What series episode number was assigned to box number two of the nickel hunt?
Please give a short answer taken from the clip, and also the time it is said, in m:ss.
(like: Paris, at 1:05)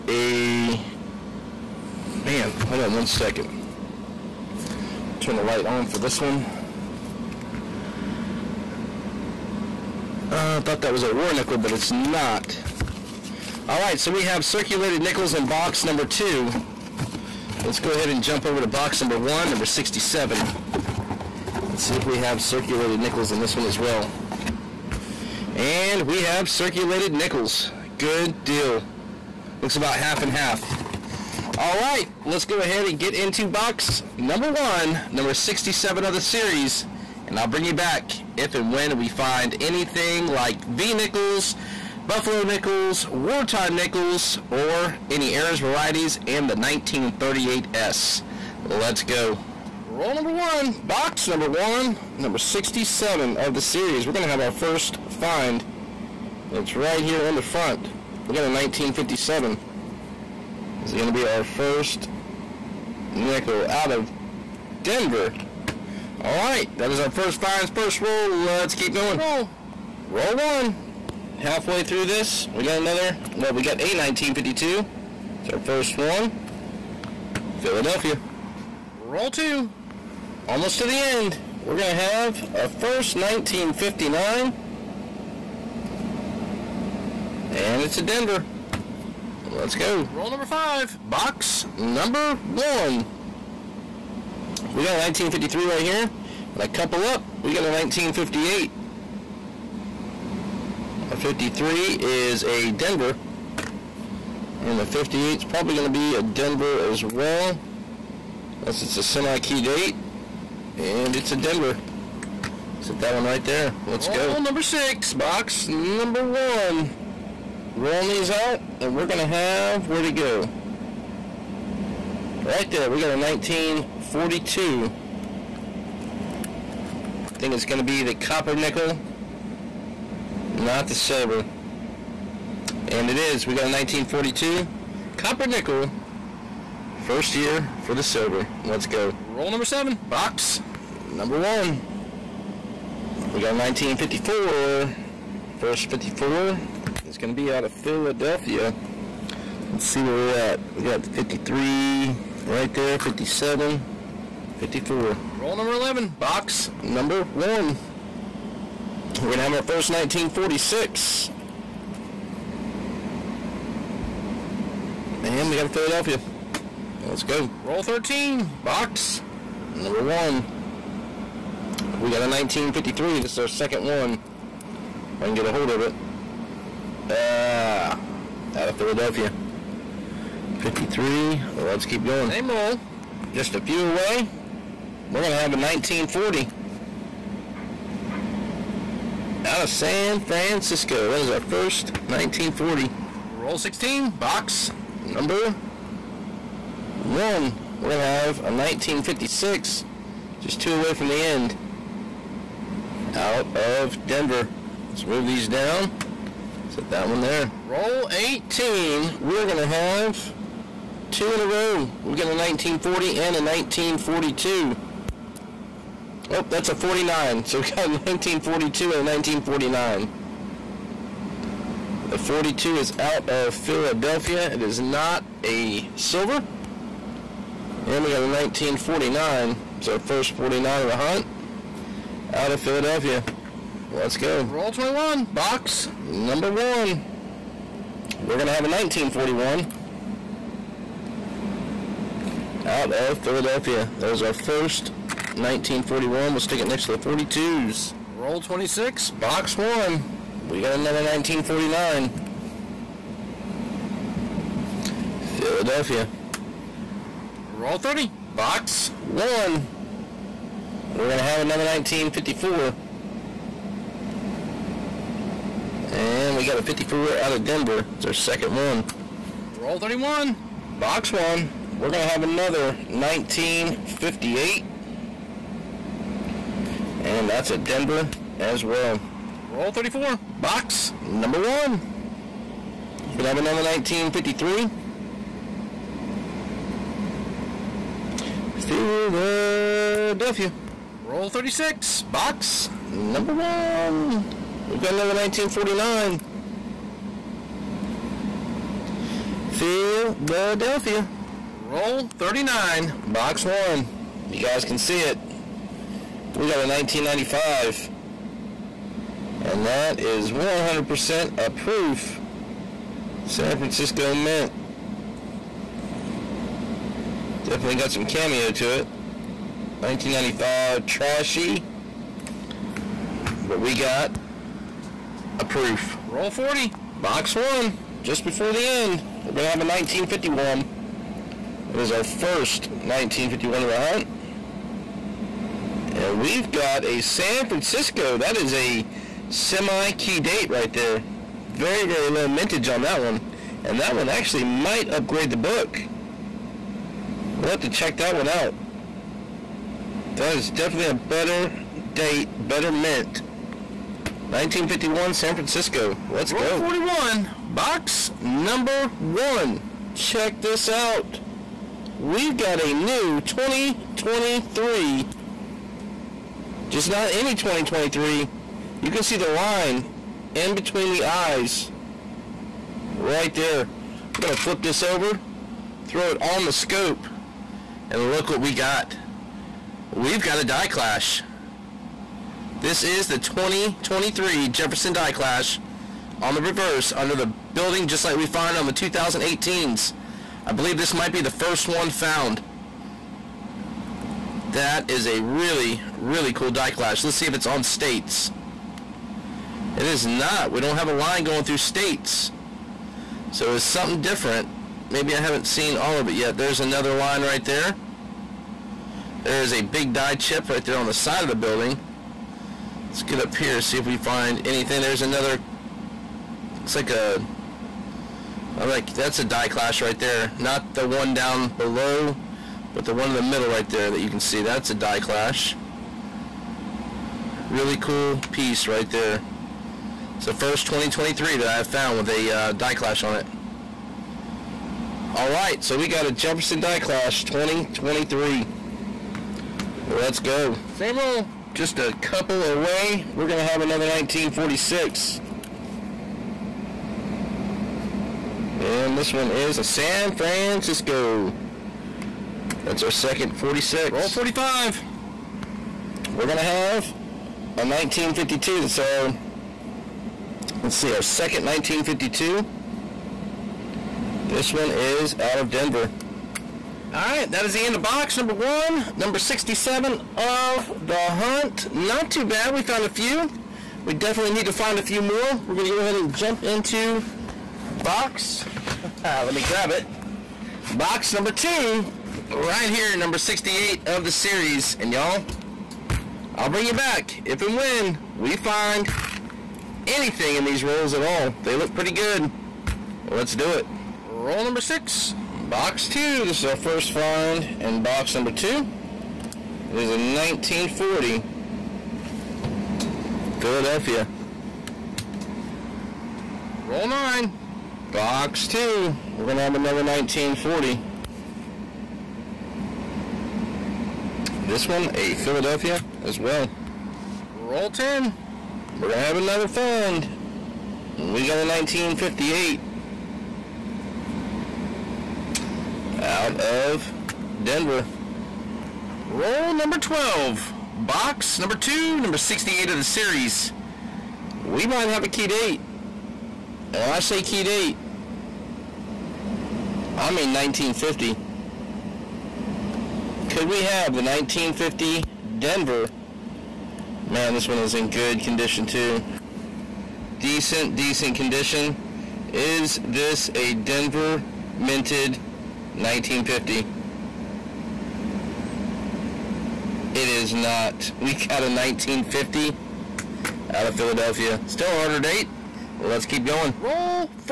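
68, at 8:00.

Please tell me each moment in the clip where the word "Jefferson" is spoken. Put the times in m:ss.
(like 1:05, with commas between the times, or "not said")
6:24, 7:16.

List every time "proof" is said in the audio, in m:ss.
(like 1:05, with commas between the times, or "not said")
5:11, 5:25.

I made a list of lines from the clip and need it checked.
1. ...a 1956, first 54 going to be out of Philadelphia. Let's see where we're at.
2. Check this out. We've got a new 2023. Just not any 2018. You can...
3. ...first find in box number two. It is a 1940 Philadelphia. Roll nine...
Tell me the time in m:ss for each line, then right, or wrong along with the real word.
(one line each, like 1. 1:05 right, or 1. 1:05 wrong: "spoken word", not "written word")
1. 2:23 wrong: "1954", not "1956"
2. 5:59 wrong: "2023", not "2018"
3. 8:16 right.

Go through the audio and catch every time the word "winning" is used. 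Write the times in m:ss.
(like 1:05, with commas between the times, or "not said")
not said.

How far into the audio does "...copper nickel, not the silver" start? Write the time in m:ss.
2:08.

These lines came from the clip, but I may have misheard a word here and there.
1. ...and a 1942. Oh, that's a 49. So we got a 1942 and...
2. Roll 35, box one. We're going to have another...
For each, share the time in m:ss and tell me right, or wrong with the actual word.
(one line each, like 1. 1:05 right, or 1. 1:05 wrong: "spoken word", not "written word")
1. 3:33 right
2. 4:29 wrong: "31", not "35".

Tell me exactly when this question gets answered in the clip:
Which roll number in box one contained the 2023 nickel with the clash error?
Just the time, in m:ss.
5:56.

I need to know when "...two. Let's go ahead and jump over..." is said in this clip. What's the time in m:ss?
0:16.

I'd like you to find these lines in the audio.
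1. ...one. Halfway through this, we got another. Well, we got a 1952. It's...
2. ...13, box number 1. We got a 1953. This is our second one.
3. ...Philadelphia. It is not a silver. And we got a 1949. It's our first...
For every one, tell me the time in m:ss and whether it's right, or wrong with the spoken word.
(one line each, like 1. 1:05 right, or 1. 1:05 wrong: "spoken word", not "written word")
1. 1:10 right
2. 2:47 right
3. 3:43 right.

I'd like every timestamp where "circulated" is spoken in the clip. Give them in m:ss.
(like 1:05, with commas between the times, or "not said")
0:14, 0:22, 0:26.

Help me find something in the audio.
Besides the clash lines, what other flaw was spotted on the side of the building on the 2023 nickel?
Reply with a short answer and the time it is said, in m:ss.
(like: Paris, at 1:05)
Die chip, at 6:49.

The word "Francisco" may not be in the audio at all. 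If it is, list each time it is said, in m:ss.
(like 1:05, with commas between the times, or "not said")
3:10, 5:13, 5:37, 5:55, 7:30.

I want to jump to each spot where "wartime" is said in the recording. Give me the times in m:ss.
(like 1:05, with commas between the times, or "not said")
0:43.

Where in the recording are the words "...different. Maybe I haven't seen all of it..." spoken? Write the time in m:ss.
6:44.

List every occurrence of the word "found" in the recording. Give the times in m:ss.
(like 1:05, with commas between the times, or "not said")
6:31, 7:11, 7:52.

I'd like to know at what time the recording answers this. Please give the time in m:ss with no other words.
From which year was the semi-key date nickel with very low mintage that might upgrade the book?
5:29.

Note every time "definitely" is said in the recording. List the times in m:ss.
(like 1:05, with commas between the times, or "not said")
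5:17, 5:50, 7:53.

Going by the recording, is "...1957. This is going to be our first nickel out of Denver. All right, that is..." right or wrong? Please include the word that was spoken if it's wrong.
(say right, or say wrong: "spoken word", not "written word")
right.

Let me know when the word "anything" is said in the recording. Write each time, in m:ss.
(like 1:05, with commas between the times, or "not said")
0:39, 6:54, 8:09.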